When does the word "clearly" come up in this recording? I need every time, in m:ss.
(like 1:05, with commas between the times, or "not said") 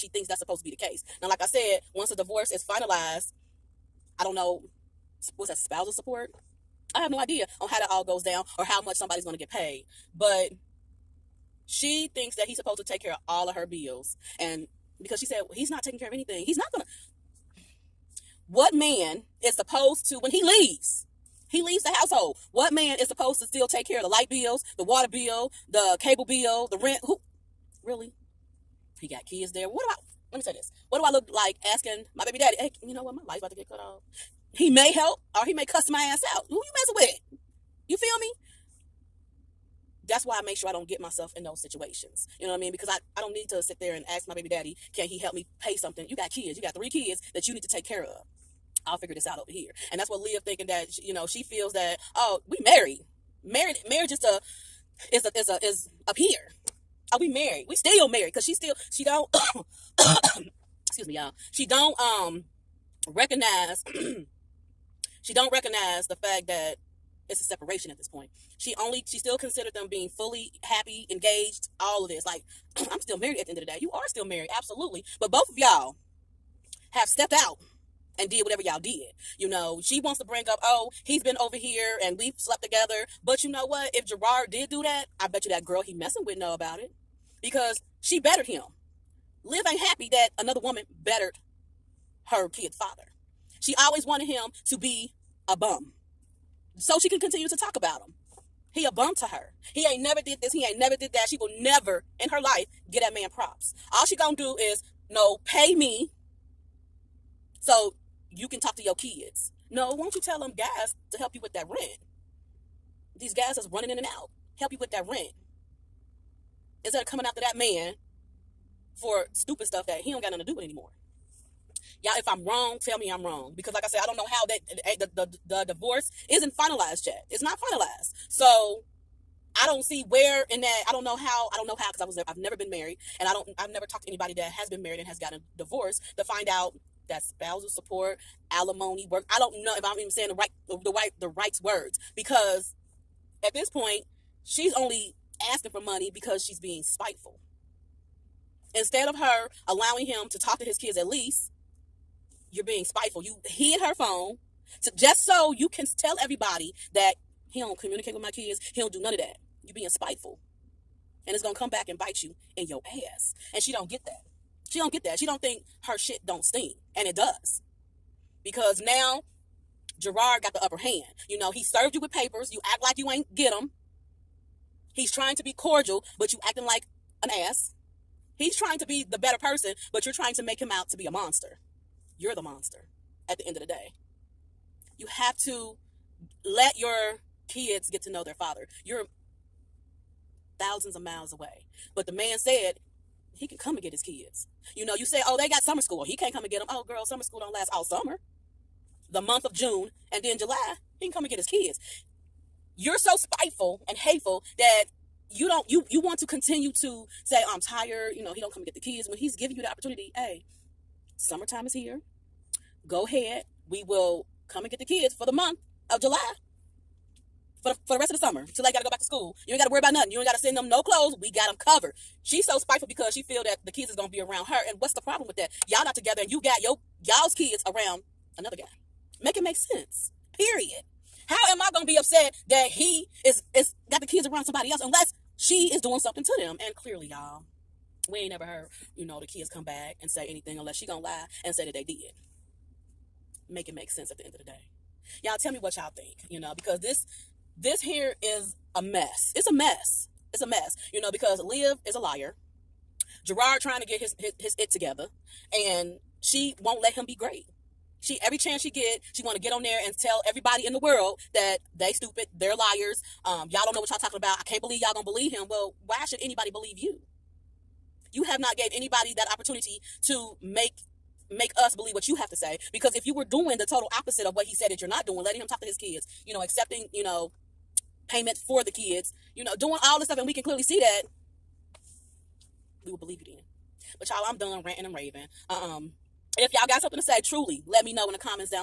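3:56, 4:40.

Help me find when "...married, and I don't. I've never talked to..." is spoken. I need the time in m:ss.
2:12.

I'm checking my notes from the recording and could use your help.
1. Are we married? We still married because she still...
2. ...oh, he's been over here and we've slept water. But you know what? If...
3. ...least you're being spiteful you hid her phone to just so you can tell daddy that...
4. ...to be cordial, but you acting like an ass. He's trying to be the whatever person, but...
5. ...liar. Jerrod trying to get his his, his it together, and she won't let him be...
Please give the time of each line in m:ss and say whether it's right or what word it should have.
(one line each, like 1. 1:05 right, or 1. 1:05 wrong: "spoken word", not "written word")
1. 0:57 right
2. 1:20 wrong: "together", not "water"
3. 2:31 wrong: "everybody", not "daddy"
4. 2:55 wrong: "better", not "whatever"
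5. 4:11 right.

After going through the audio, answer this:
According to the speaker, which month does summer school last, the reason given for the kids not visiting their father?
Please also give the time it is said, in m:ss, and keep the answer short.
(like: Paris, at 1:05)
June, at 3:19.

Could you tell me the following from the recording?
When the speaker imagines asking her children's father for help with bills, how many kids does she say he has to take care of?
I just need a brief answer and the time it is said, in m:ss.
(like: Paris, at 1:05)
3, at 0:46.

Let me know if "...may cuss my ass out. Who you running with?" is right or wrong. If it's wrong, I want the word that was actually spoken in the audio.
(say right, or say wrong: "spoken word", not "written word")
wrong: "messing", not "running".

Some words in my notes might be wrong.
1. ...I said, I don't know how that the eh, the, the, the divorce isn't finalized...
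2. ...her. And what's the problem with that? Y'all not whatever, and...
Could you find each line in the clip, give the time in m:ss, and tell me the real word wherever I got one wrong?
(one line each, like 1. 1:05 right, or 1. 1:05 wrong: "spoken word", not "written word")
1. 2:03 right
2. 3:44 wrong: "together", not "whatever".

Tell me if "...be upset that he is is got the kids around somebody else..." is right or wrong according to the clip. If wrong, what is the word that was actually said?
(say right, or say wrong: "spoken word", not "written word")
right.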